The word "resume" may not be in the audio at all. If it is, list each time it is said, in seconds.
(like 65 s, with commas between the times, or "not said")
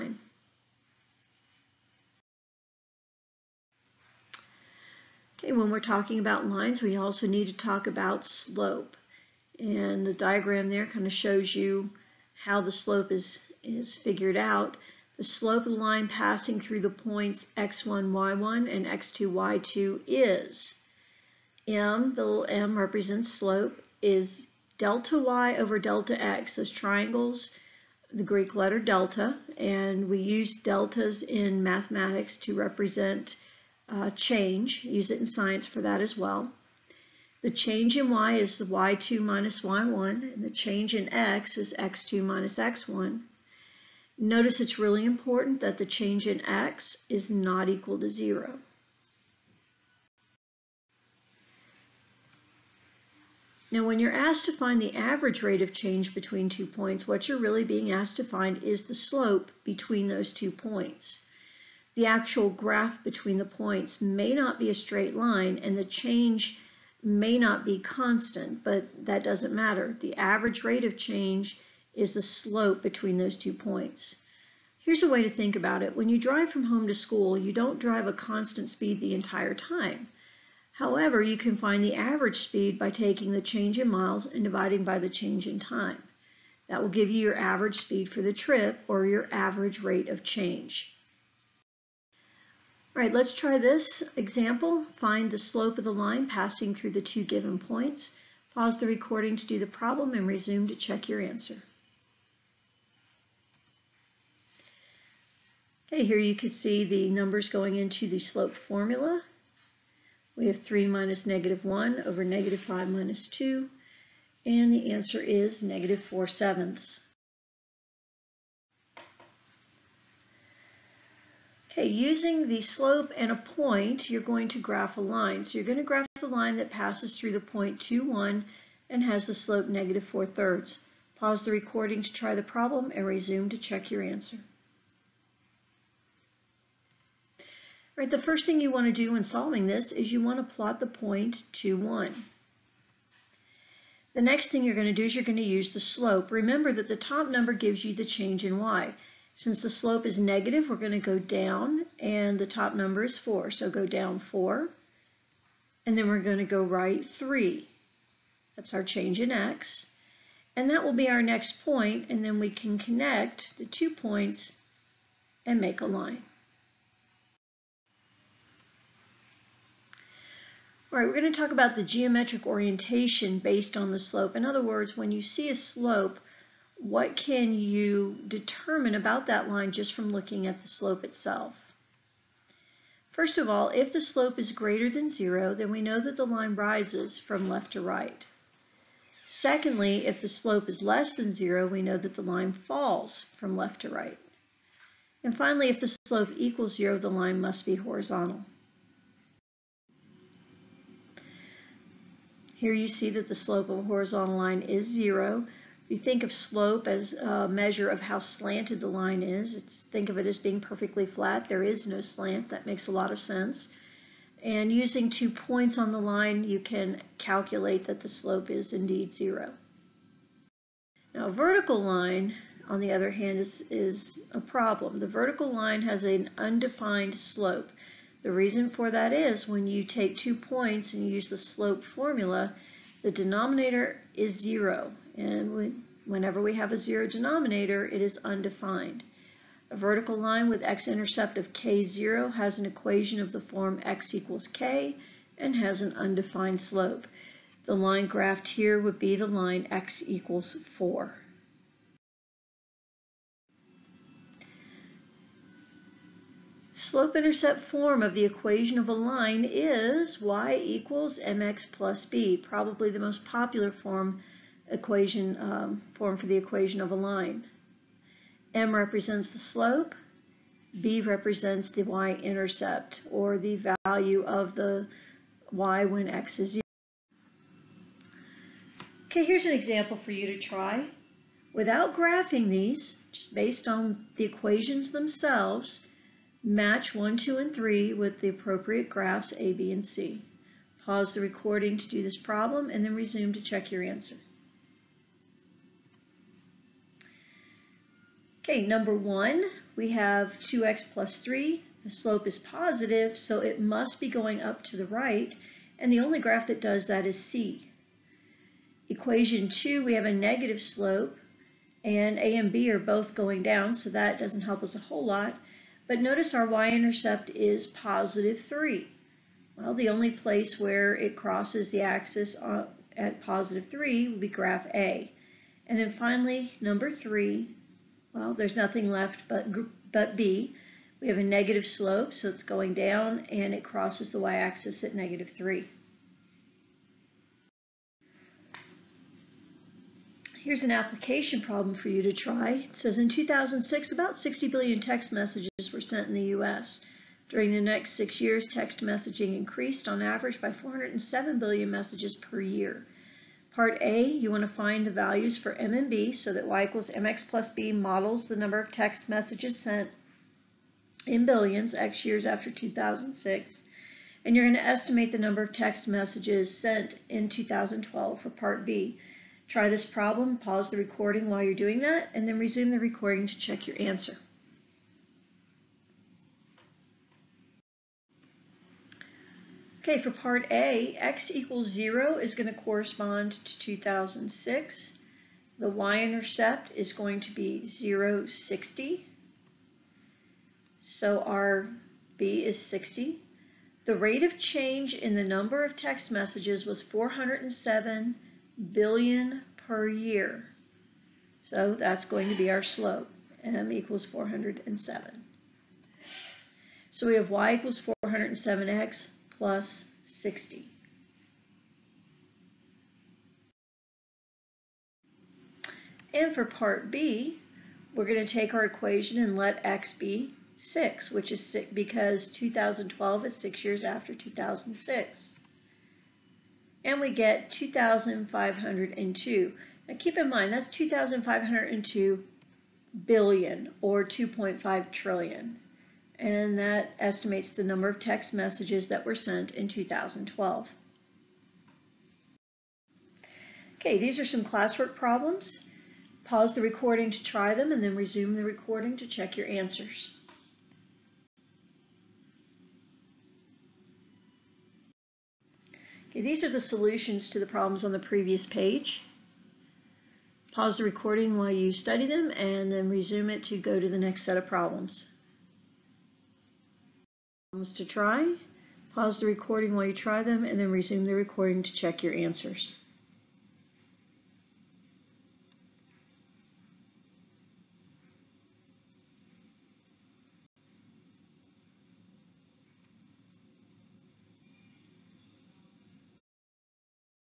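100 s, 133 s, 292 s, 372 s, 447 s, 462 s, 470 s.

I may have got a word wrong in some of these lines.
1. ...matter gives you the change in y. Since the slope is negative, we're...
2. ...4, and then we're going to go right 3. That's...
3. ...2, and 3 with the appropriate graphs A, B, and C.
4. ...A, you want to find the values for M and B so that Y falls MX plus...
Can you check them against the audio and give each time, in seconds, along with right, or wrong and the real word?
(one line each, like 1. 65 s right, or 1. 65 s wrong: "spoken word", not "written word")
1. 147 s wrong: "number", not "matter"
2. 154 s right
3. 287 s right
4. 353 s wrong: "equals", not "falls".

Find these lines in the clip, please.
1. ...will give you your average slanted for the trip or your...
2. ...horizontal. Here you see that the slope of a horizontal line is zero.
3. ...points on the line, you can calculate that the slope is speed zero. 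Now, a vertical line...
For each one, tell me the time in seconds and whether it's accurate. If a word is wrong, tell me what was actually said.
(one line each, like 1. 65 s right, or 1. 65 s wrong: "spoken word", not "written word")
1. 86 s wrong: "speed", not "slanted"
2. 197 s right
3. 215 s wrong: "indeed", not "speed".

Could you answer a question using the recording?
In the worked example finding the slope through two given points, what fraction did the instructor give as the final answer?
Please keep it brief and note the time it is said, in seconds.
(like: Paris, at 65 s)
-4/7, at 115 s.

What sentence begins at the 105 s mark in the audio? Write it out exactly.
Okay, here you can see the numbers going into the slope formula.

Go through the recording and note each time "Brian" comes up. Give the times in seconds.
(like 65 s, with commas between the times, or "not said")
not said.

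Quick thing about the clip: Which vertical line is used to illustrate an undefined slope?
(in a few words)
x = 4.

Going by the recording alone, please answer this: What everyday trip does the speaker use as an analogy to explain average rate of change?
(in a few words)
home to school.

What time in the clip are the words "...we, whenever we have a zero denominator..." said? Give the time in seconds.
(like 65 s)
235 s.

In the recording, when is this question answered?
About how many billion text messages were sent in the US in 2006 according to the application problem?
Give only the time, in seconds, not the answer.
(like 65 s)
344 s.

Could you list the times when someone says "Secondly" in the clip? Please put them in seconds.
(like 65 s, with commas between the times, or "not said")
189 s.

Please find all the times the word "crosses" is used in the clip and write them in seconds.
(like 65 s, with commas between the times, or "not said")
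321 s, 333 s.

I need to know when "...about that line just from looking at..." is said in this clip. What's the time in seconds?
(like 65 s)
178 s.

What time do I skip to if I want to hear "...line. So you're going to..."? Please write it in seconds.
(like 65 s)
125 s.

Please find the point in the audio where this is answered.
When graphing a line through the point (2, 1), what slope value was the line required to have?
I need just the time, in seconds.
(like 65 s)
129 s.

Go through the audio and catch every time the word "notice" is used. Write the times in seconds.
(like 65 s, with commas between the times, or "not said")
44 s, 316 s.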